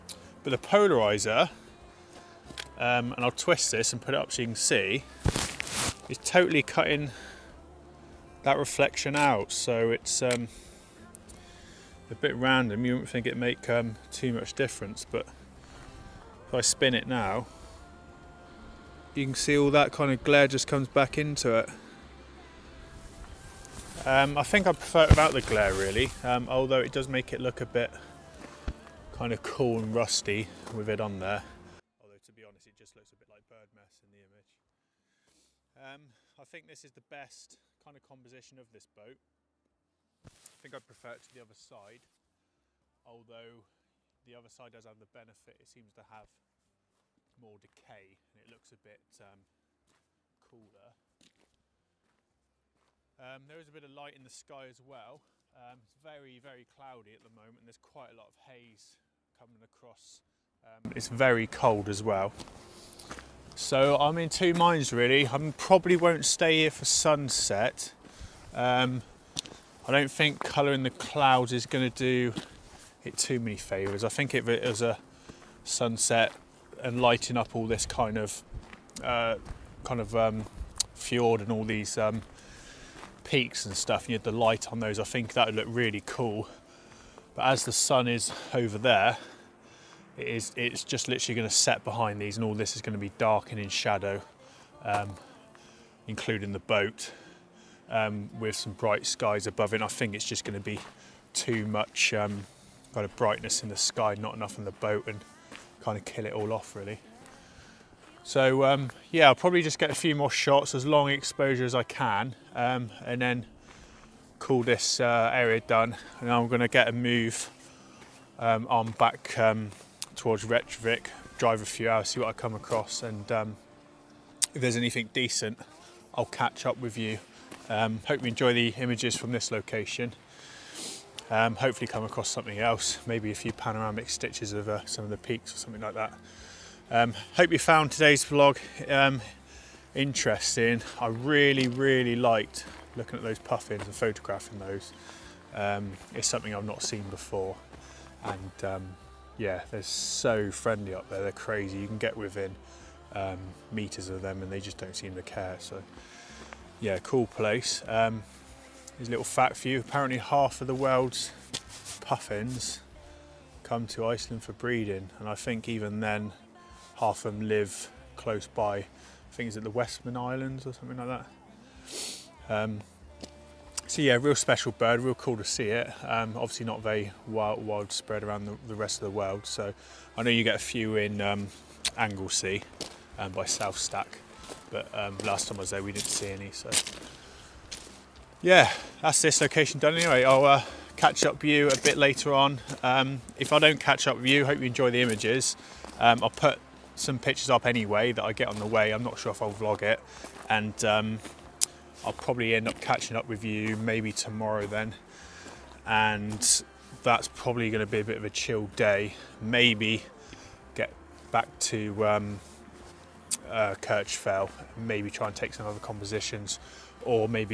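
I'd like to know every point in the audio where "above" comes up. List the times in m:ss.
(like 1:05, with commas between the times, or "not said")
1:39.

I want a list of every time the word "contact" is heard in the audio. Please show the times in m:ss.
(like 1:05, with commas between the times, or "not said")
not said.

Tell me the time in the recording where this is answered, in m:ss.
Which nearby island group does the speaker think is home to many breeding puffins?
2:49.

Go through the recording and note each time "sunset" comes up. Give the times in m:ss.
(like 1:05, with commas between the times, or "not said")
1:06, 1:15.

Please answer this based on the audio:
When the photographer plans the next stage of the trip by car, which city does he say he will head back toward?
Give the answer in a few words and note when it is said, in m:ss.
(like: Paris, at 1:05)
Reykjavik, at 2:00.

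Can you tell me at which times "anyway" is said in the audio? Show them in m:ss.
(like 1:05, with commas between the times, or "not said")
3:09, 3:17.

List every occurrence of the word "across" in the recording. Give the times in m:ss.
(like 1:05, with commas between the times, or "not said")
0:59, 2:02, 2:12.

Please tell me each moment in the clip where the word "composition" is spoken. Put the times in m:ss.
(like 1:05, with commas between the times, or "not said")
0:38, 3:35.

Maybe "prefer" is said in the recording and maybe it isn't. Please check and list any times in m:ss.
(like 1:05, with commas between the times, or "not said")
0:24, 0:40.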